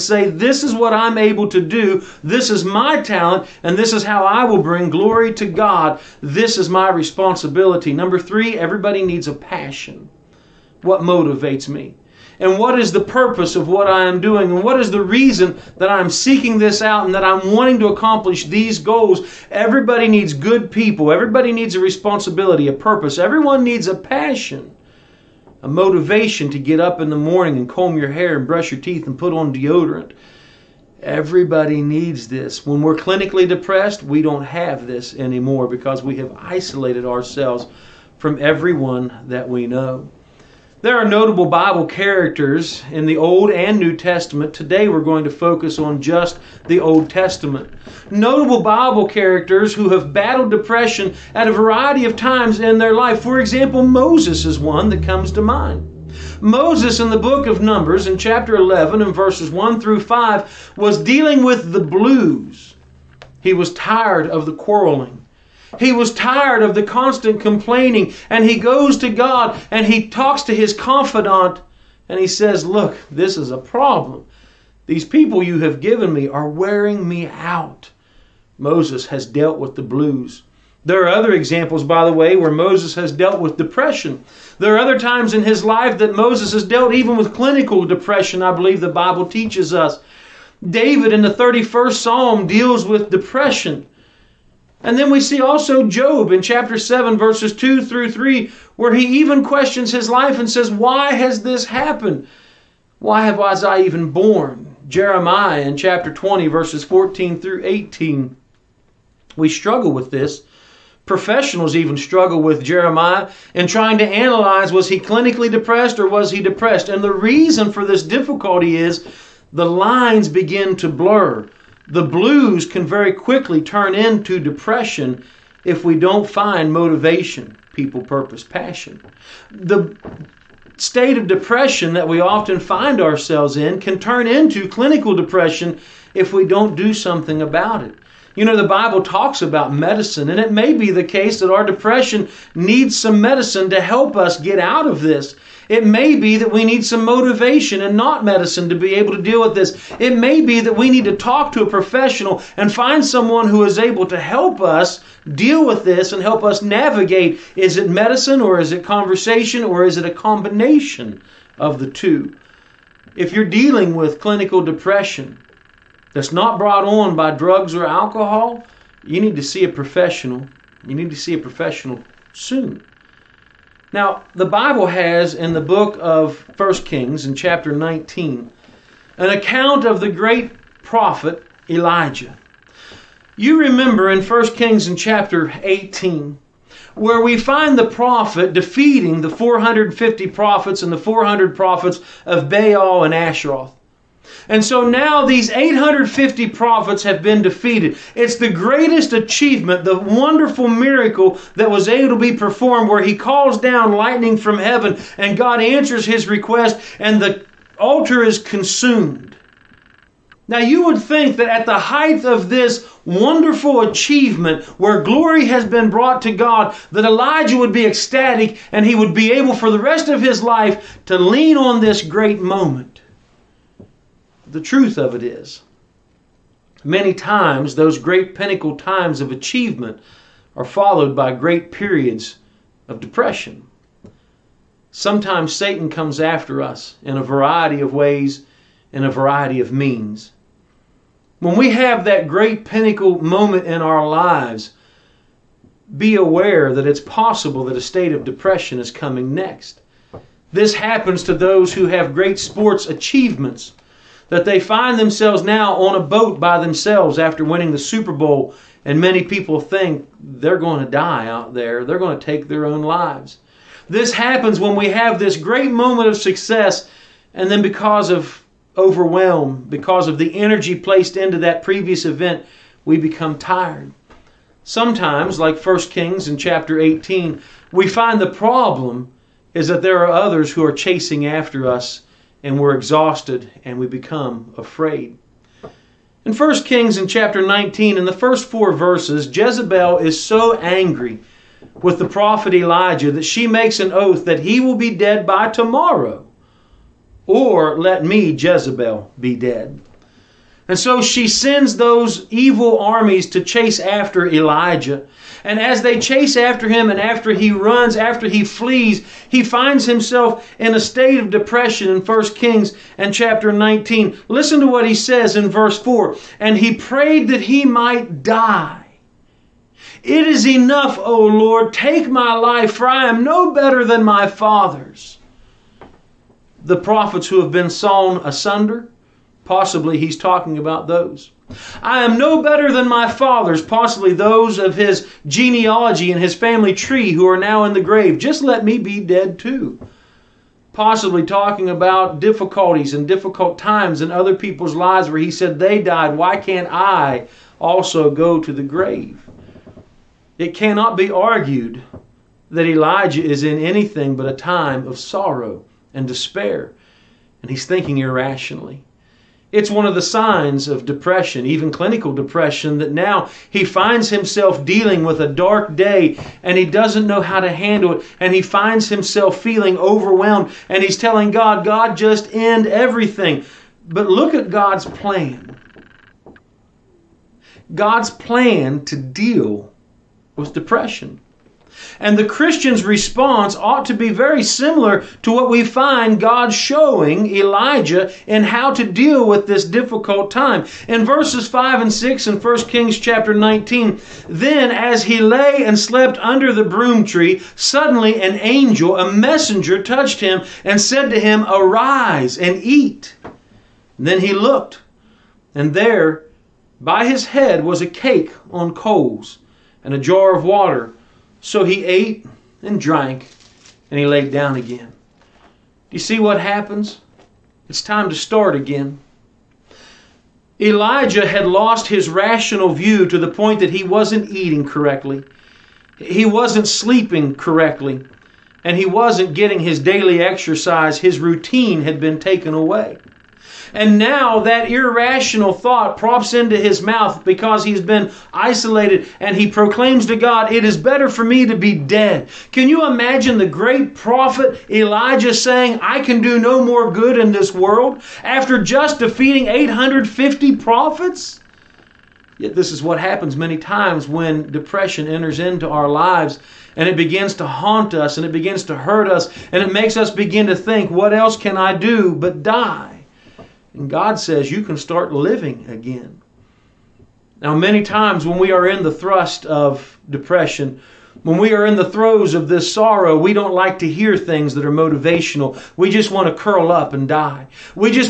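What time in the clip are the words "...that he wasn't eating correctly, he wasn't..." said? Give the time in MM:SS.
07:03.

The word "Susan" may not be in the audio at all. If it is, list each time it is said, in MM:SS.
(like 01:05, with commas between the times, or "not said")
not said.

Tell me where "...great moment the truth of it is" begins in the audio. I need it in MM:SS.
03:42.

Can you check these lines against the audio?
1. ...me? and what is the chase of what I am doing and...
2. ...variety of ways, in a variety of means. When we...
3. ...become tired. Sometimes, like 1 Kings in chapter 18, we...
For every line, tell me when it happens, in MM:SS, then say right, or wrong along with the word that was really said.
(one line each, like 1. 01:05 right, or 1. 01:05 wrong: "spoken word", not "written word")
1. 00:11 wrong: "purpose", not "chase"
2. 03:57 right
3. 04:32 right.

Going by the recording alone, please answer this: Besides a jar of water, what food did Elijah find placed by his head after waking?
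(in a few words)
A cake on coals.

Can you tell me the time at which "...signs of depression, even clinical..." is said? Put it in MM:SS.
06:00.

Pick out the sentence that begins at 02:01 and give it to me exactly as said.
The blues can very quickly turn into depression if we don't find motivation, people, purpose, passion.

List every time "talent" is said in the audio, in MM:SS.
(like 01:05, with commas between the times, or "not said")
00:03.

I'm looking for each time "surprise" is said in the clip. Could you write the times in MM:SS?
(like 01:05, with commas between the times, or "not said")
not said.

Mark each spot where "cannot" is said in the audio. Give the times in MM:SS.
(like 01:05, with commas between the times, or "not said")
05:50.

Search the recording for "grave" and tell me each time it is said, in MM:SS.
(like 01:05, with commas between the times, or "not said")
05:37, 05:48.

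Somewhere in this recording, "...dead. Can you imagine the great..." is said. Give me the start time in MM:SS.
07:21.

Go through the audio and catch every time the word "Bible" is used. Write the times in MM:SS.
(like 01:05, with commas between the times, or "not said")
00:41, 00:48, 01:28, 02:18, 02:54.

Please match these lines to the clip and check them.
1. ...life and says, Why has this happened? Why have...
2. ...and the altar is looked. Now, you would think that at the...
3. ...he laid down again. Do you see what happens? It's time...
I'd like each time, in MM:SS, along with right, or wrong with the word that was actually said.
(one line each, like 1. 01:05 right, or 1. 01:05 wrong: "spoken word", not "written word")
1. 01:40 right
2. 03:26 wrong: "consumed", not "looked"
3. 06:53 right.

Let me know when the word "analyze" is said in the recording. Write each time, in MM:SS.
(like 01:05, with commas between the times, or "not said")
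01:54.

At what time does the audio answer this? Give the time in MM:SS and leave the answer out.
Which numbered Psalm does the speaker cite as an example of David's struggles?
01:31.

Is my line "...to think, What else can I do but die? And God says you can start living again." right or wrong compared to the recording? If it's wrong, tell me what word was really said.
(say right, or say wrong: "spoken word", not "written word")
right.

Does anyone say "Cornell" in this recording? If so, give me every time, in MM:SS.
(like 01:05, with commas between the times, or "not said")
not said.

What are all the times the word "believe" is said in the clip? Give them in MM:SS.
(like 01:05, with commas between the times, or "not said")
01:28.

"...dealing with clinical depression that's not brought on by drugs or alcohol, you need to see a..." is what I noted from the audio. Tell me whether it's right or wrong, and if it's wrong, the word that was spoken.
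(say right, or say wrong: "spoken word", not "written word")
right.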